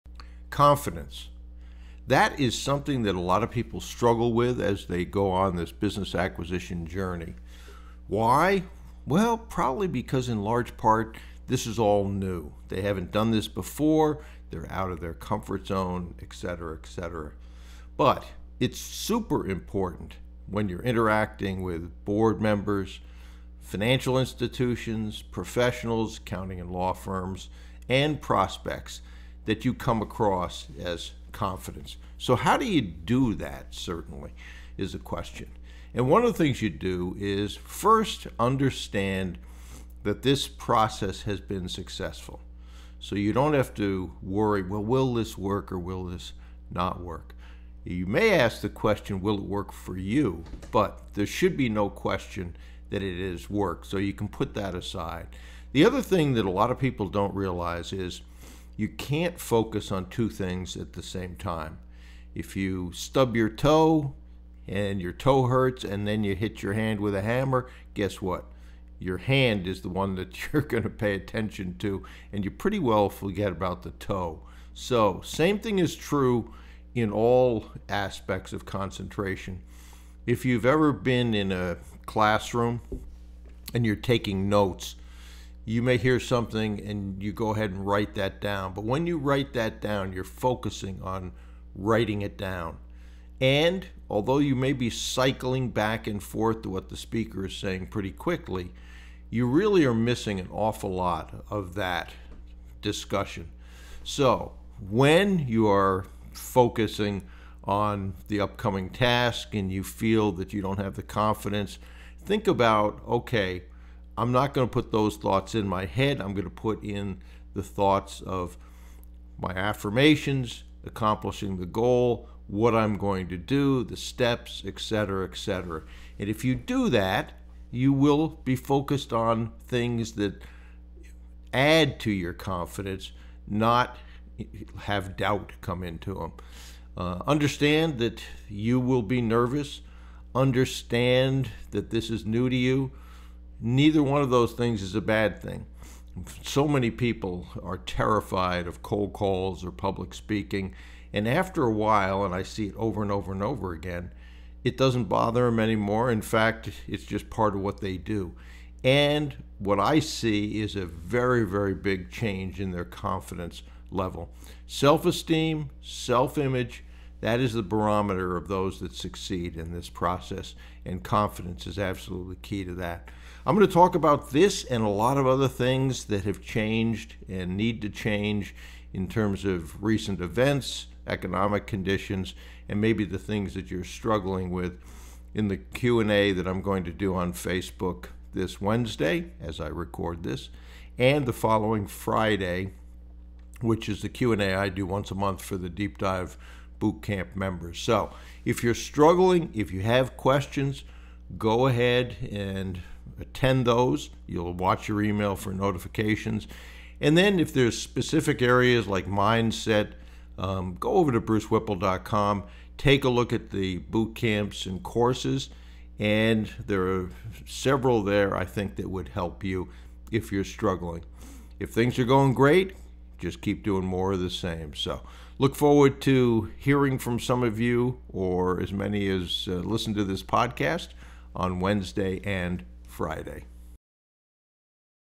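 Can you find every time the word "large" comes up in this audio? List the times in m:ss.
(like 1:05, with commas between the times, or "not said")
0:10.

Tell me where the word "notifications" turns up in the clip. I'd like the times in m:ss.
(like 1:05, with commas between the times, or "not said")
3:25.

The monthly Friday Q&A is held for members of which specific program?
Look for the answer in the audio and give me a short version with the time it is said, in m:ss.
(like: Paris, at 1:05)
deep dive boot camp, at 3:15.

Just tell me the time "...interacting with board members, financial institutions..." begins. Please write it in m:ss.
0:20.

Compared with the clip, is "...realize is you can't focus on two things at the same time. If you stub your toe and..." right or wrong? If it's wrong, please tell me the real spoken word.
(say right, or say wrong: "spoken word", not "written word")
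right.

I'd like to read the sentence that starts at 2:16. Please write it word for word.
Uh, understand that you will be nervous.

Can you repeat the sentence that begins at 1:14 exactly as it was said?
So, same thing is true in all aspects of concentration.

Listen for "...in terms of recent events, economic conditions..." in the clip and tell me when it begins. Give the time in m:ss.
2:58.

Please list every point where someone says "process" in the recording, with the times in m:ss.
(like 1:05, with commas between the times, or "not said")
0:40, 2:49.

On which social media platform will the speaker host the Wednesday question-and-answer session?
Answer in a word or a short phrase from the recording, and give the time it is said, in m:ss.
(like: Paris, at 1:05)
Facebook, at 3:07.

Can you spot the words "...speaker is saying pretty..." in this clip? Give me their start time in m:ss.
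1:36.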